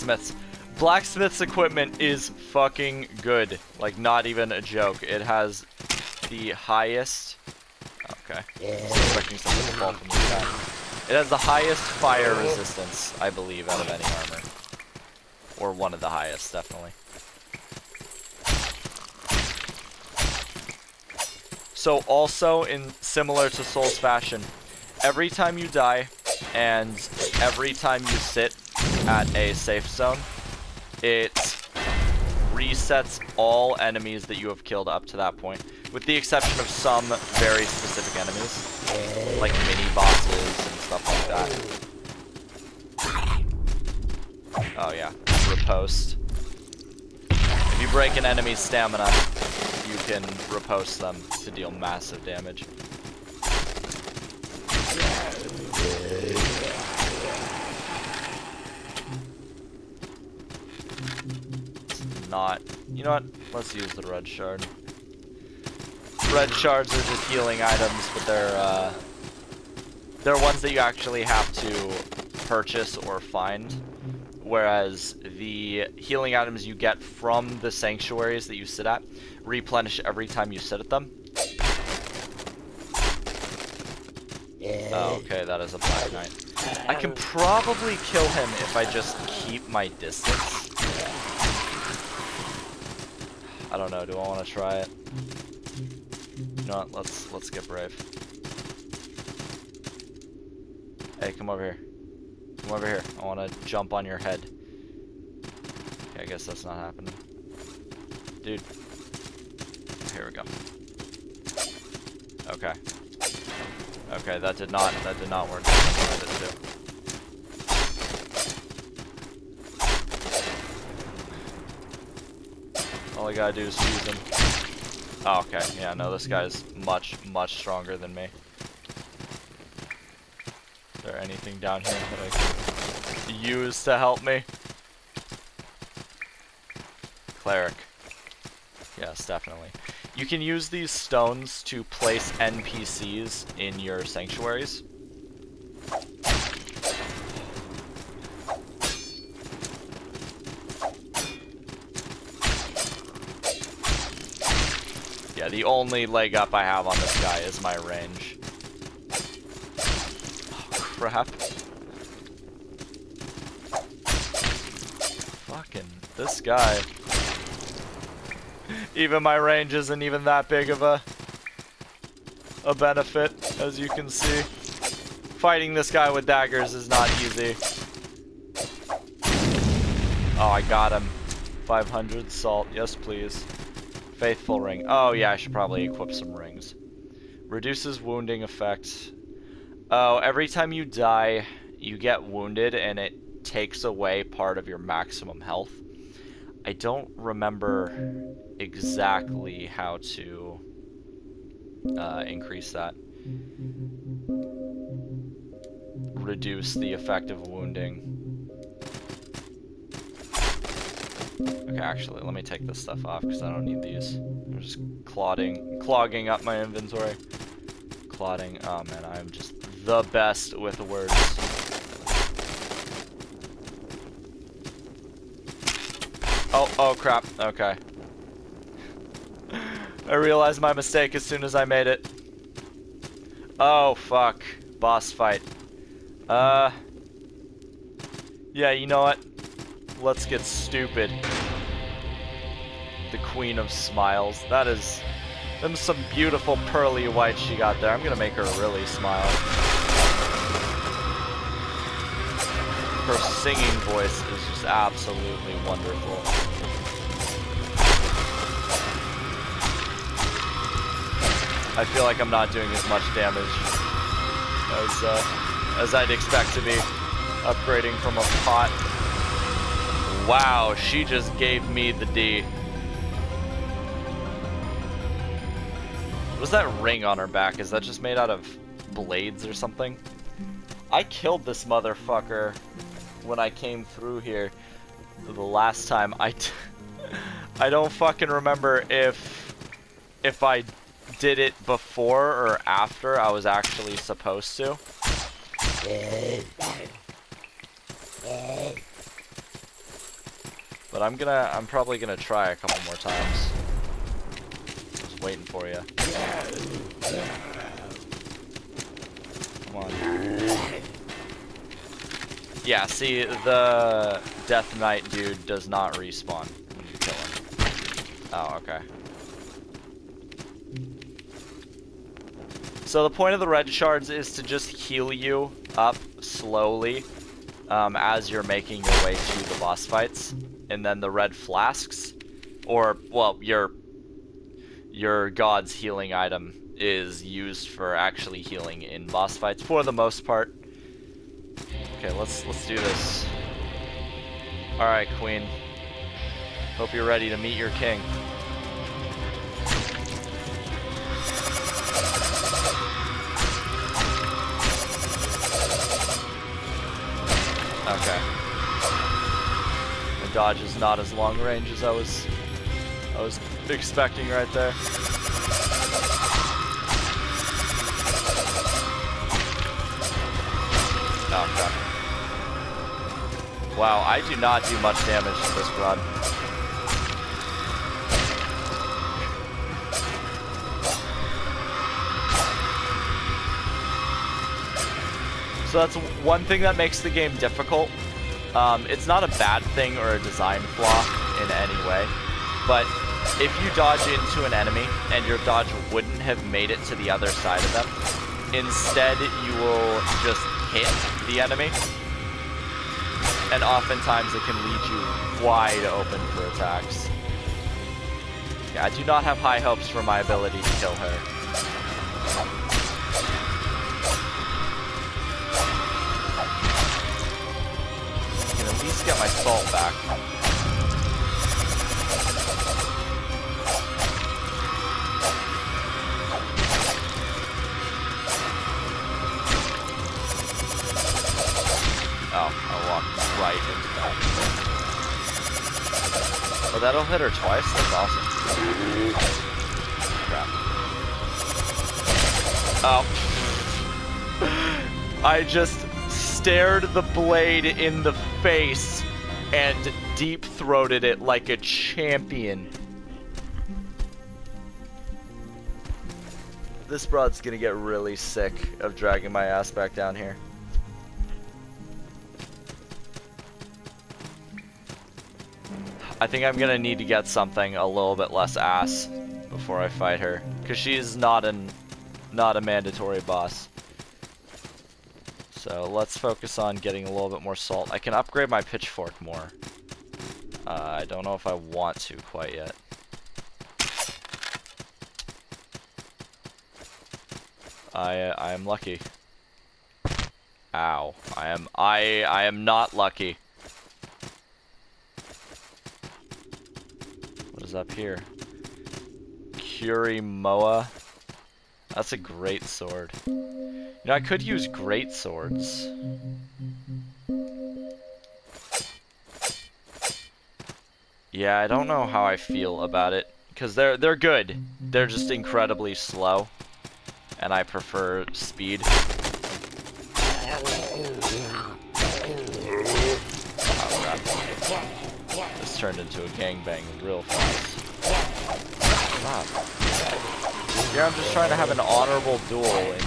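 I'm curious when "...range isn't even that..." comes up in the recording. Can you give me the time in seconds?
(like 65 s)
169 s.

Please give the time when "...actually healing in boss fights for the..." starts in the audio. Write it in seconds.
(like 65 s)
337 s.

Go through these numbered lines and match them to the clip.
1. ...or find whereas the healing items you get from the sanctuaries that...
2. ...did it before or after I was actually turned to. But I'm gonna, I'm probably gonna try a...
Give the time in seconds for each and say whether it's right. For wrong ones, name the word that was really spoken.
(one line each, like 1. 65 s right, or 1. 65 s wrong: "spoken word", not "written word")
1. 72 s right
2. 291 s wrong: "supposed", not "turned".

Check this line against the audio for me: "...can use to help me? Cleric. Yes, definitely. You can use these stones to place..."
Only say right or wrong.
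right.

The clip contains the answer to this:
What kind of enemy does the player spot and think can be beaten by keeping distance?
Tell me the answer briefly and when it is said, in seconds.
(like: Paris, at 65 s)
Black knight, at 85 s.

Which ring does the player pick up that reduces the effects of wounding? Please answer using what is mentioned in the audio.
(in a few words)
Faithful ring.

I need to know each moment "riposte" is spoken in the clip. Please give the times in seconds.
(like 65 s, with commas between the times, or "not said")
45 s, 50 s.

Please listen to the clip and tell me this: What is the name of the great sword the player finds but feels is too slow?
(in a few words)
Kurimoa.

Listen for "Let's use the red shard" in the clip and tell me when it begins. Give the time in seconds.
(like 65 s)
63 s.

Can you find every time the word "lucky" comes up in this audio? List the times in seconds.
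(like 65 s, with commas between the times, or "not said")
488 s, 492 s.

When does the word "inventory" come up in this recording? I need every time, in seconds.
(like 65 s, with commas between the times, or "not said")
216 s.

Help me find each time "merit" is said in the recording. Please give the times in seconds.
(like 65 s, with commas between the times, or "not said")
not said.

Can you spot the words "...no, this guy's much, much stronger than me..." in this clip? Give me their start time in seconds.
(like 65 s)
125 s.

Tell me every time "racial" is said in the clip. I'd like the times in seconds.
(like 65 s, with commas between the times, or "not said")
not said.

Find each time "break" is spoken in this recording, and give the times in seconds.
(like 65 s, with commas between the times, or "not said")
47 s.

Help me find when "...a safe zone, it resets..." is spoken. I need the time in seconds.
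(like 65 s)
29 s.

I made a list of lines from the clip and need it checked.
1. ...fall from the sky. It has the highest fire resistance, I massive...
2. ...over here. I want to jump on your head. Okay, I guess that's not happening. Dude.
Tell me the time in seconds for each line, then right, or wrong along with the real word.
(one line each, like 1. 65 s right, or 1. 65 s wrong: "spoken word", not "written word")
1. 9 s wrong: "believe", not "massive"
2. 102 s right.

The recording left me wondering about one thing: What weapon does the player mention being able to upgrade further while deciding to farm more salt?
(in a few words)
Pitchfork.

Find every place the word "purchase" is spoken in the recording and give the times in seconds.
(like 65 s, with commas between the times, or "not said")
72 s.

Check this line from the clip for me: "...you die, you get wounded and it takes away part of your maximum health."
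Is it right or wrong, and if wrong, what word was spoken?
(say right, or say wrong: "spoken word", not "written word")
right.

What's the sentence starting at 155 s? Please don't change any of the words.
Yeah, the only leg up I have on this guy is my range for a half.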